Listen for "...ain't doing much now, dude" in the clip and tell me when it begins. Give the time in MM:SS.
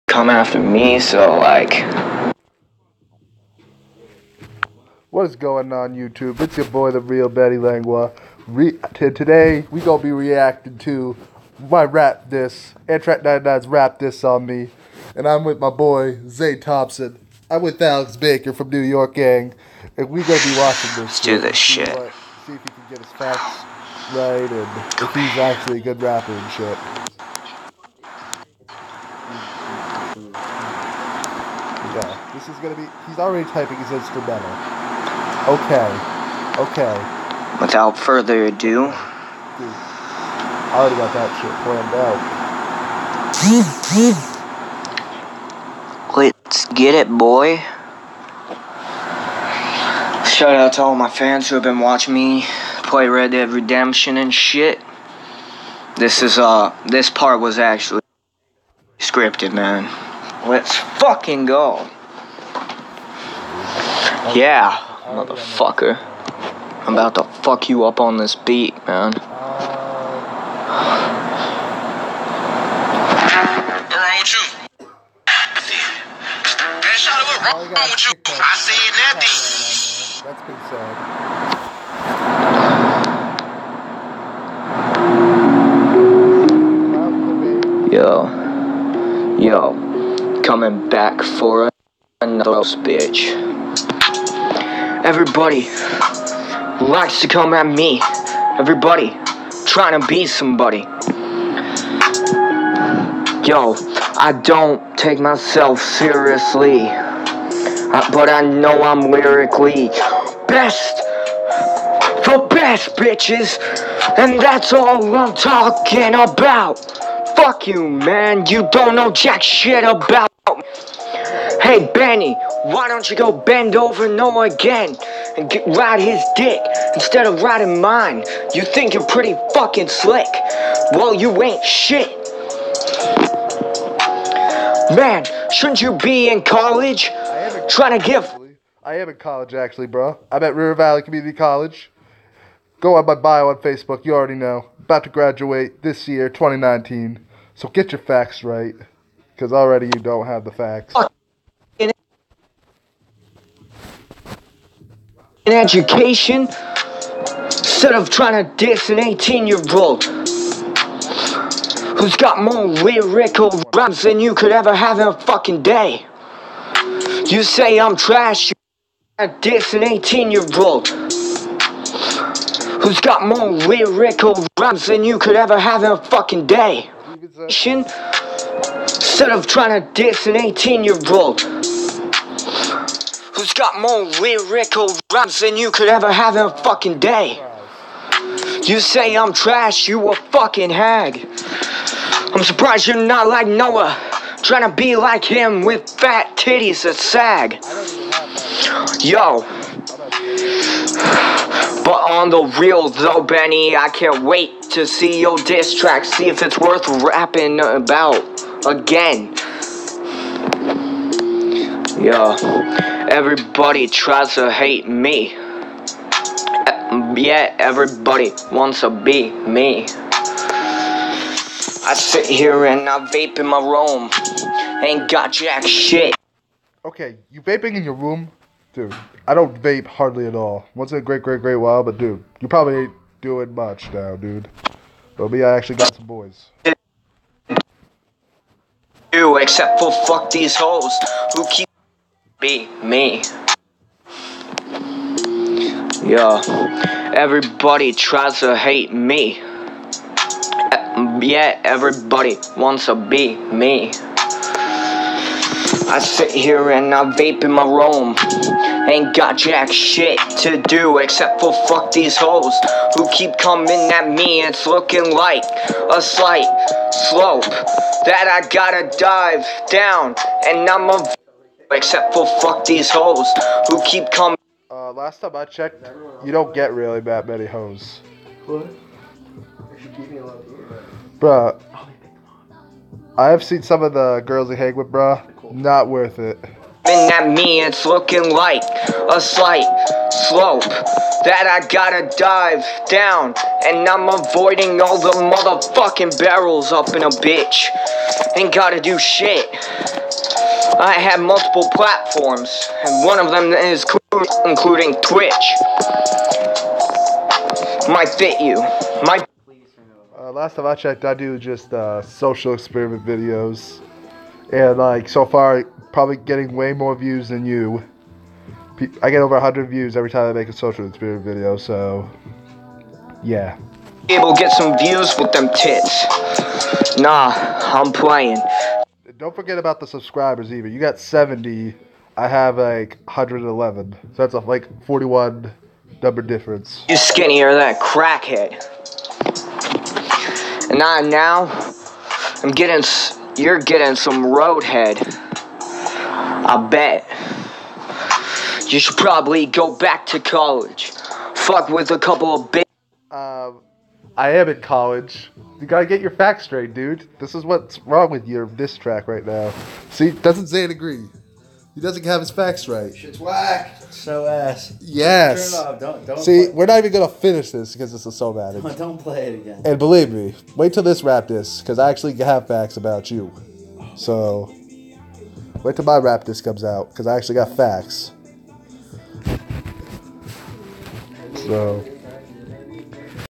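03:52.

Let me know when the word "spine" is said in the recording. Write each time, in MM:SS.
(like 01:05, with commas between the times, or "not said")
not said.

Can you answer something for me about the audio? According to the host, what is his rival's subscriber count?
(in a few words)
70.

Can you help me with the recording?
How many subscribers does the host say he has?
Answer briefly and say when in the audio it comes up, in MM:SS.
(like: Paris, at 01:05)
111, at 05:33.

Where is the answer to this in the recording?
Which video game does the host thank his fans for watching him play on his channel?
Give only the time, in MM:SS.
00:53.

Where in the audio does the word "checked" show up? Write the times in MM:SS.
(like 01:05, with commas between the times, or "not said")
04:35, 05:10.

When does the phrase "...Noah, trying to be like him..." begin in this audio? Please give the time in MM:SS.
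03:13.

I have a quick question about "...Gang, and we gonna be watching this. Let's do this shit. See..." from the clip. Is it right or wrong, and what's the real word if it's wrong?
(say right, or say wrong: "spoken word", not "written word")
right.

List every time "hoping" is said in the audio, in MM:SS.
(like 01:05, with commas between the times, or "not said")
not said.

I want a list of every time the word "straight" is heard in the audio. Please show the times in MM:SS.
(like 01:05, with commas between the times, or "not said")
05:56.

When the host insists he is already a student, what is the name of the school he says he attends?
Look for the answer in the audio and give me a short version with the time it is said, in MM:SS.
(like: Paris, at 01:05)
River Valley Community College, at 02:20.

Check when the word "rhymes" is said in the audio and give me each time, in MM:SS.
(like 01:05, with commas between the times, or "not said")
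02:43, 02:54, 03:05.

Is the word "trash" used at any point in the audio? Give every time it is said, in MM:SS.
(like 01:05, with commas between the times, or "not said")
02:47, 03:09.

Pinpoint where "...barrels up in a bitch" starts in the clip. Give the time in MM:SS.
04:56.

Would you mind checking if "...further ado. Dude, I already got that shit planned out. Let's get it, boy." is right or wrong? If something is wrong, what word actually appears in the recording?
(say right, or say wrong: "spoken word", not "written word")
right.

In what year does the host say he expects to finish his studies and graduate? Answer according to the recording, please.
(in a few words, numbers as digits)
2019.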